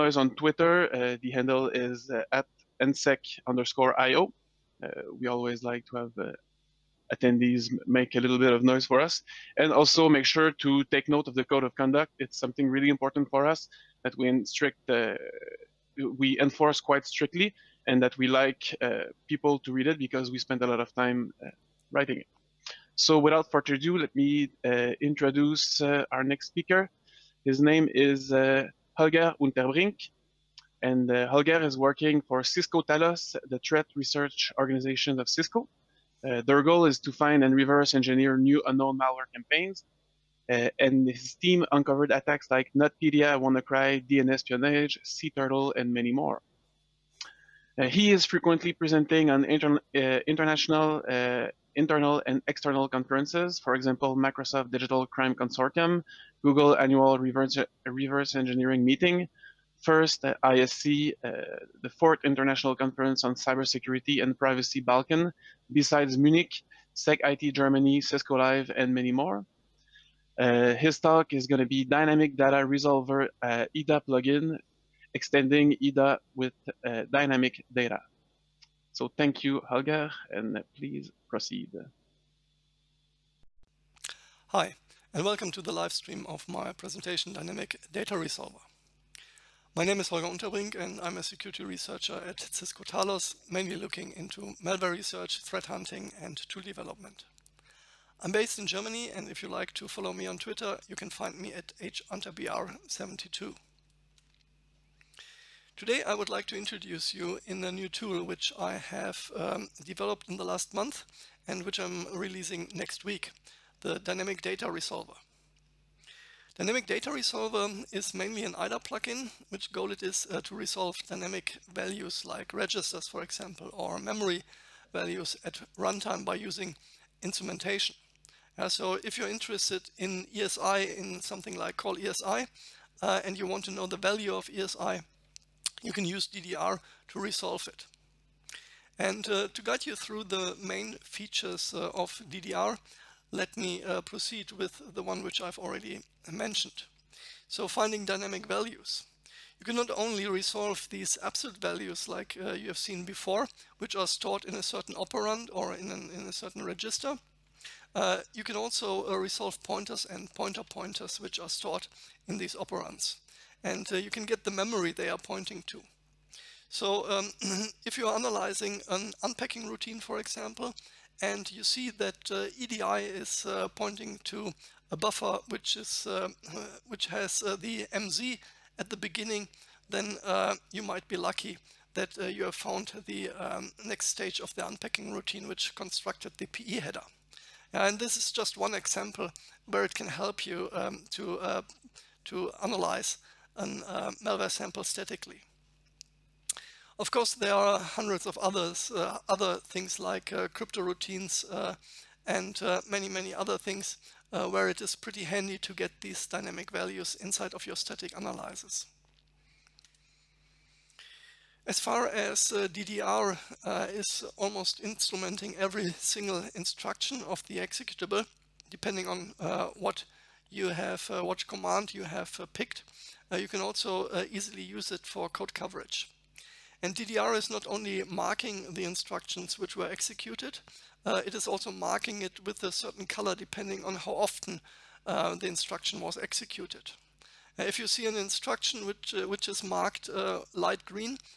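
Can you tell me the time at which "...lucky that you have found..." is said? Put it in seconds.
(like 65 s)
181 s.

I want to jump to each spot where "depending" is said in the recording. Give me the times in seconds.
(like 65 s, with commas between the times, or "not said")
218 s, 233 s.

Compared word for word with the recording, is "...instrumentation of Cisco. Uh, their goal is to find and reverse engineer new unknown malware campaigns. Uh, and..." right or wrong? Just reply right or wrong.
wrong.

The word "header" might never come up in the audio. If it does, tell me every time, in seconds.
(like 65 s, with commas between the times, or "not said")
186 s.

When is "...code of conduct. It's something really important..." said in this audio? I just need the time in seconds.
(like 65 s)
11 s.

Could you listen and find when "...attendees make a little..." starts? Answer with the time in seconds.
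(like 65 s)
7 s.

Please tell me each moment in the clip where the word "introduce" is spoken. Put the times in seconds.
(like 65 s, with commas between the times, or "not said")
25 s, 106 s.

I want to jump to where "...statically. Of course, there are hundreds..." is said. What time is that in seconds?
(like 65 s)
194 s.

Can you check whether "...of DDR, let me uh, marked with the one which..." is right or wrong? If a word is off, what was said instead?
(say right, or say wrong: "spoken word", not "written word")
wrong: "proceed", not "marked".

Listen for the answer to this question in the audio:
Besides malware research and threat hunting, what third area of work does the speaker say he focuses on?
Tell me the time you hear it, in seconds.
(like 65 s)
96 s.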